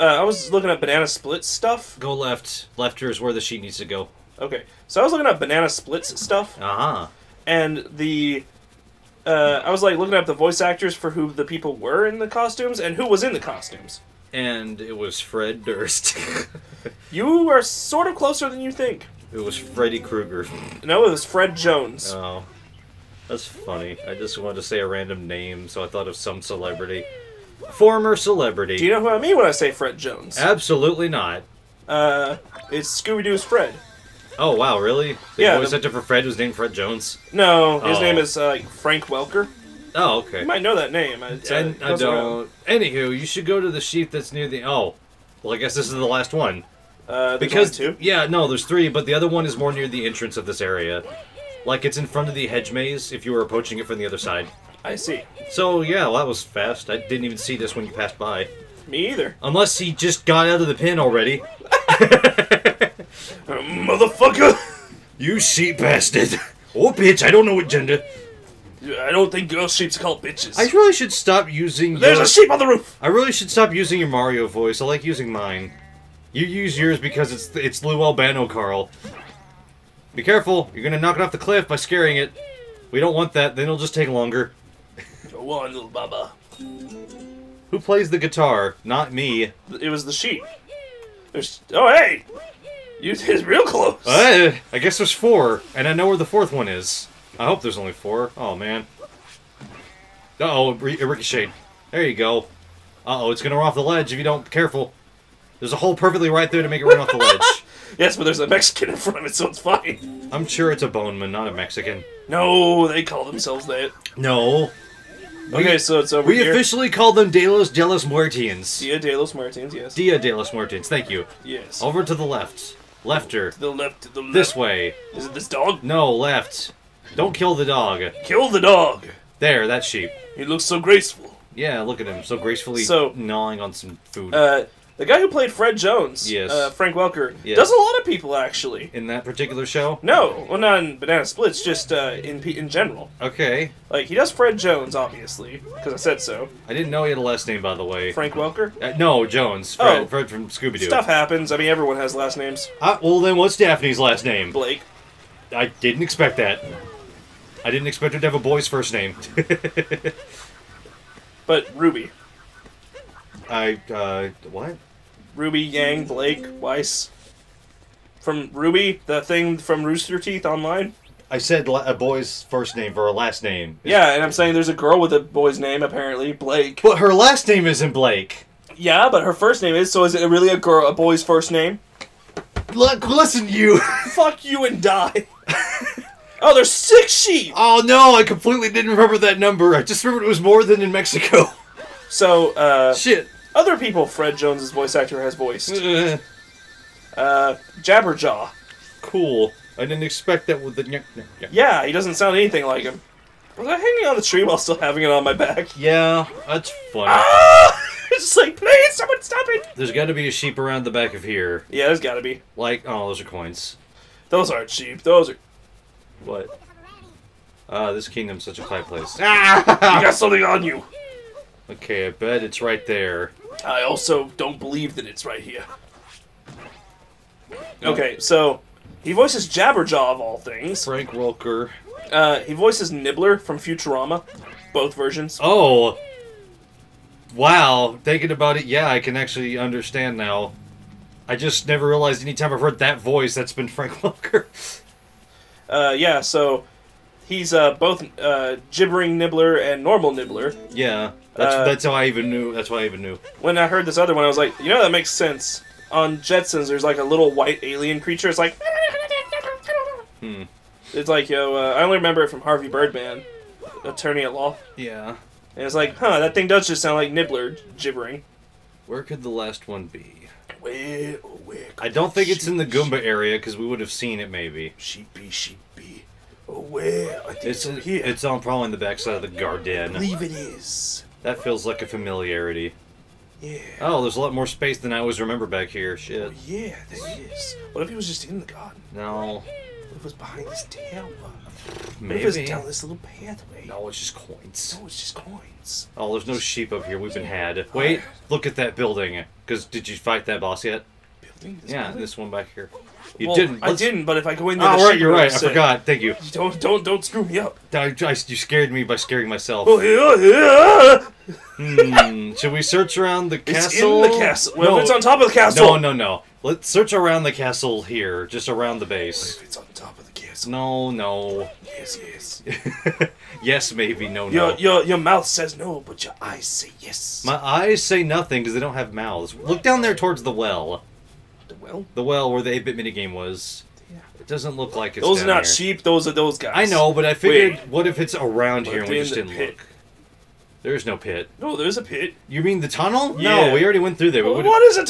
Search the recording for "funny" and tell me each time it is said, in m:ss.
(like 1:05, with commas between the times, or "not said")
0:23, 3:26.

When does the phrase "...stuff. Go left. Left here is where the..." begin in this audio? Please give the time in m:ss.
0:01.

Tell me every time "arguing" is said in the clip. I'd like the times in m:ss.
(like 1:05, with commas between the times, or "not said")
not said.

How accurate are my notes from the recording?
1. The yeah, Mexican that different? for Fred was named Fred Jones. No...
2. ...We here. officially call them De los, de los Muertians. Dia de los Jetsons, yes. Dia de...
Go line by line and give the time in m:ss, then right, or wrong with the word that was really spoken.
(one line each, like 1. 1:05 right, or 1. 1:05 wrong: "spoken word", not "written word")
1. 0:35 wrong: "Was", not "Mexican"
2. 1:56 wrong: "Muertians", not "Jetsons".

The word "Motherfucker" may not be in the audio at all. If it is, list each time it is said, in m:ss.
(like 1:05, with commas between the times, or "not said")
1:03.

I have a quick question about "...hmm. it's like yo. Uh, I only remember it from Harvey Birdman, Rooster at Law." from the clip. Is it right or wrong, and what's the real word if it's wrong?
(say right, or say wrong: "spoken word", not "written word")
wrong: "Attorney", not "Rooster".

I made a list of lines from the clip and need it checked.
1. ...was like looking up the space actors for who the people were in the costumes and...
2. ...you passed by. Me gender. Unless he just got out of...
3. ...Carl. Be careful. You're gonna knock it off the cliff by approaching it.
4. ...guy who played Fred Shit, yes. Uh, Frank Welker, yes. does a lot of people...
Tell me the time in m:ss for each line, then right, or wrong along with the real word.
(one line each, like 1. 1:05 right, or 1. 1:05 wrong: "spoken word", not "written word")
1. 0:09 wrong: "voice", not "space"
2. 0:57 wrong: "either", not "gender"
3. 1:18 wrong: "scaring", not "approaching"
4. 2:15 wrong: "Jones", not "Shit".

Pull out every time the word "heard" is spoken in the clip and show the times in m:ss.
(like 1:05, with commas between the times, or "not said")
4:02, 4:13.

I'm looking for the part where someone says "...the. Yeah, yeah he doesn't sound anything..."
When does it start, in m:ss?
3:20.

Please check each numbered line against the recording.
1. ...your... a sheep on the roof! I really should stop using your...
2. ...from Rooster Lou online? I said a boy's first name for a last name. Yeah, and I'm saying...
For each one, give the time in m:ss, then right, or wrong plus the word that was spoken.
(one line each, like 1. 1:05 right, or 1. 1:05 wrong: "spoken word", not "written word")
1. 1:12 right
2. 2:49 wrong: "Teeth", not "Lou".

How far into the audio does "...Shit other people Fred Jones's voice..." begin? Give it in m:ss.
3:12.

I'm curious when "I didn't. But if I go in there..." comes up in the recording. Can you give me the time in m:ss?
5:03.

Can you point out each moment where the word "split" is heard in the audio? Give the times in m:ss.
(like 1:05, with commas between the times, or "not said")
0:01, 0:05, 2:21.